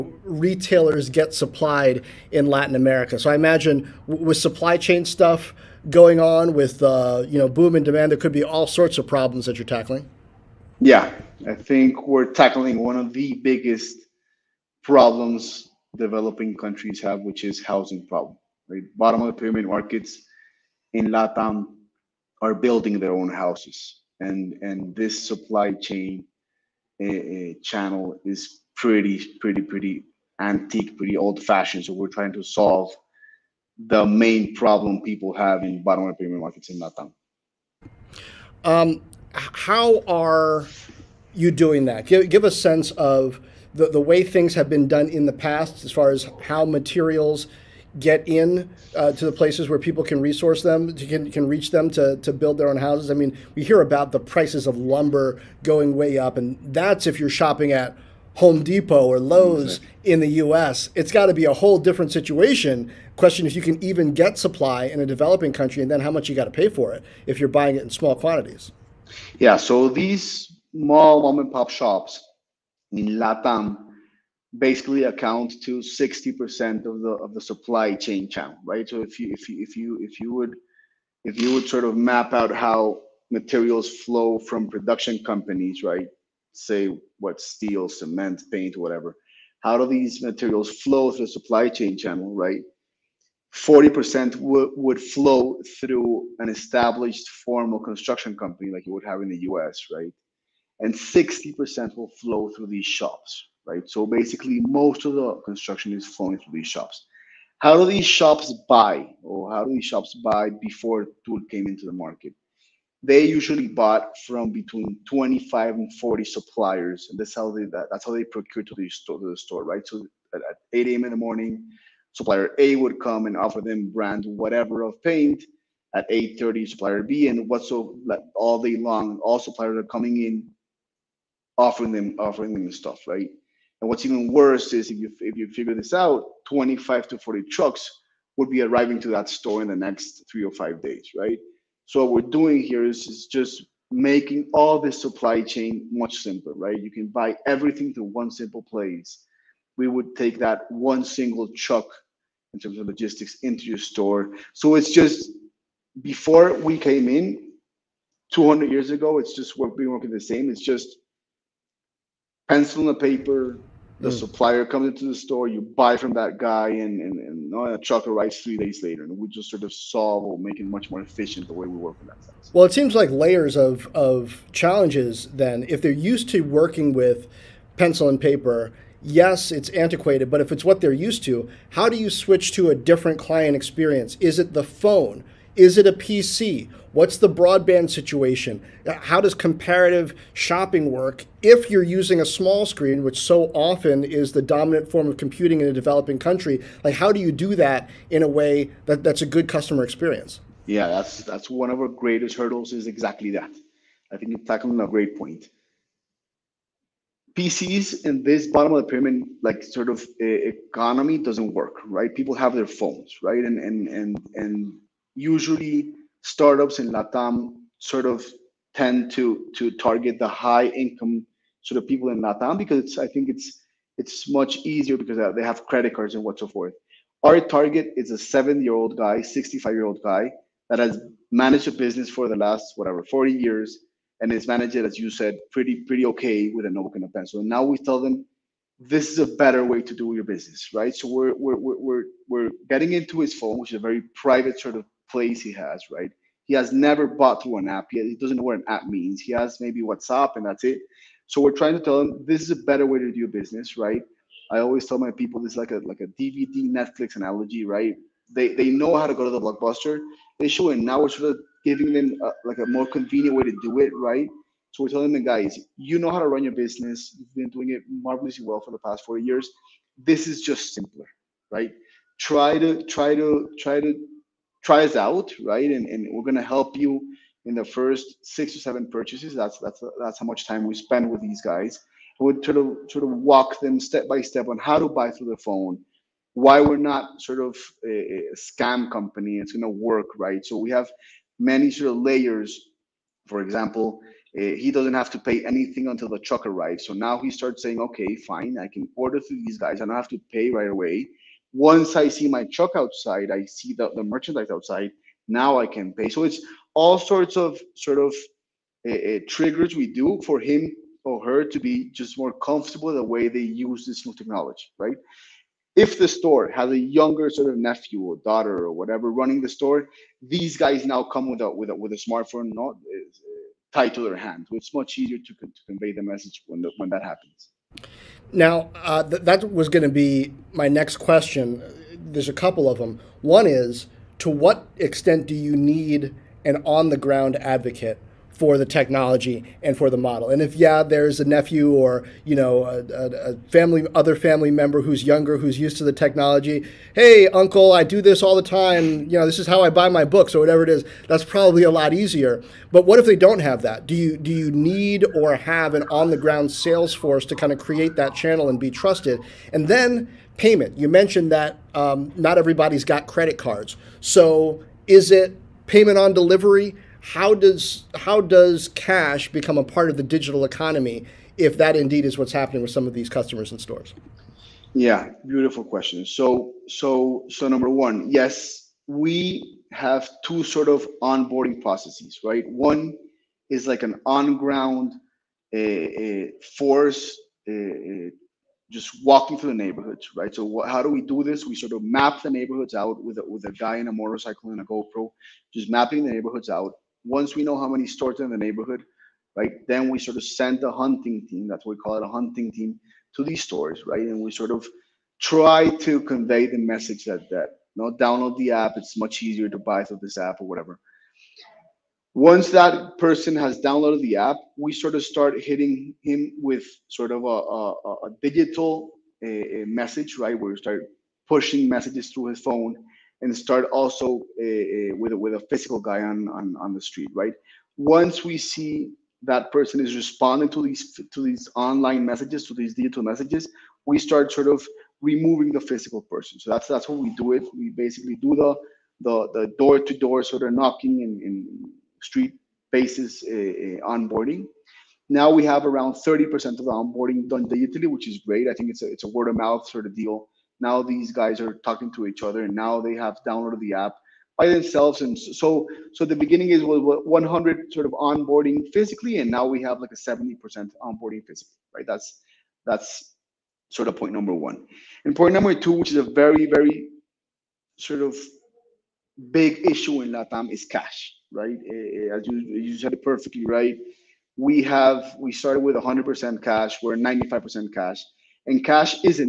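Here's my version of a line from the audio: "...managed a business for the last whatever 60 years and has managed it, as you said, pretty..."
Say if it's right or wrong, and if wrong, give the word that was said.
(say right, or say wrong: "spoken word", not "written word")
wrong: "40", not "60".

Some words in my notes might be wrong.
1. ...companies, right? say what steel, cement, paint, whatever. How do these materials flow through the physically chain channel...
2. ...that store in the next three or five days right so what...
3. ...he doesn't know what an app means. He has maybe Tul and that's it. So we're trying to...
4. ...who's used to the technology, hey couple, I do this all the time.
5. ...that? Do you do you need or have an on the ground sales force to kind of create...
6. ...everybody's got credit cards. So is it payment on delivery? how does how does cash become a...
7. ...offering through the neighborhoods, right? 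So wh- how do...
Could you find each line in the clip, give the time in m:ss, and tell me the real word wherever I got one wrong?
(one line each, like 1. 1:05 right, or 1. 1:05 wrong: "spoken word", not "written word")
1. 1:25 wrong: "supply", not "physically"
2. 2:19 right
3. 4:08 wrong: "WhatsApp", not "Tul"
4. 5:45 wrong: "uncle", not "couple"
5. 5:53 right
6. 6:02 right
7. 6:29 wrong: "walking", not "offering".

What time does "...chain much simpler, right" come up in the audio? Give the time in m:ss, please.
2:25.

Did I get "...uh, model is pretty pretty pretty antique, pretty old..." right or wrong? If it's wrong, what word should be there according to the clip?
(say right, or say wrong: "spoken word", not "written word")
wrong: "channel", not "model".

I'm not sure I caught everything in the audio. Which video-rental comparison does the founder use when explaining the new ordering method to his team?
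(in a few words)
DVD Netflix analogy.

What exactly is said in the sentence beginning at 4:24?
So we're telling the guys, you know how to run your business.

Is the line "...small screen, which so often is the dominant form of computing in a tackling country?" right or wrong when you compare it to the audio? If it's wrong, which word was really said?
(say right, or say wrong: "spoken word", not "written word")
wrong: "developing", not "tackling".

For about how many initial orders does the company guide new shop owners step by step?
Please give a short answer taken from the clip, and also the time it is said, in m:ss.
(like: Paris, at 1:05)
6 or 7, at 4:37.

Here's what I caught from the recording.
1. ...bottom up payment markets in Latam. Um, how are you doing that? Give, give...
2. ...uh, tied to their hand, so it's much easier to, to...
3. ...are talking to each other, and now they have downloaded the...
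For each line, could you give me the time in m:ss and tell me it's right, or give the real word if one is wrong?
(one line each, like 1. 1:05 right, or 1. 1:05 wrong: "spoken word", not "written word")
1. 0:35 right
2. 5:22 right
3. 7:31 right.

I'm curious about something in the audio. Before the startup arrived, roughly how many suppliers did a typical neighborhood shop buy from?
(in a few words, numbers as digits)
25 to 40.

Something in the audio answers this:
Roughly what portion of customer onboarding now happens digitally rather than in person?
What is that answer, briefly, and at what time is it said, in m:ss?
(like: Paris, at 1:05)
30%, at 7:25.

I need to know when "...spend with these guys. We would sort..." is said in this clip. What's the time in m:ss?
4:40.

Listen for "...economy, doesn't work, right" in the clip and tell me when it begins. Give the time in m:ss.
3:30.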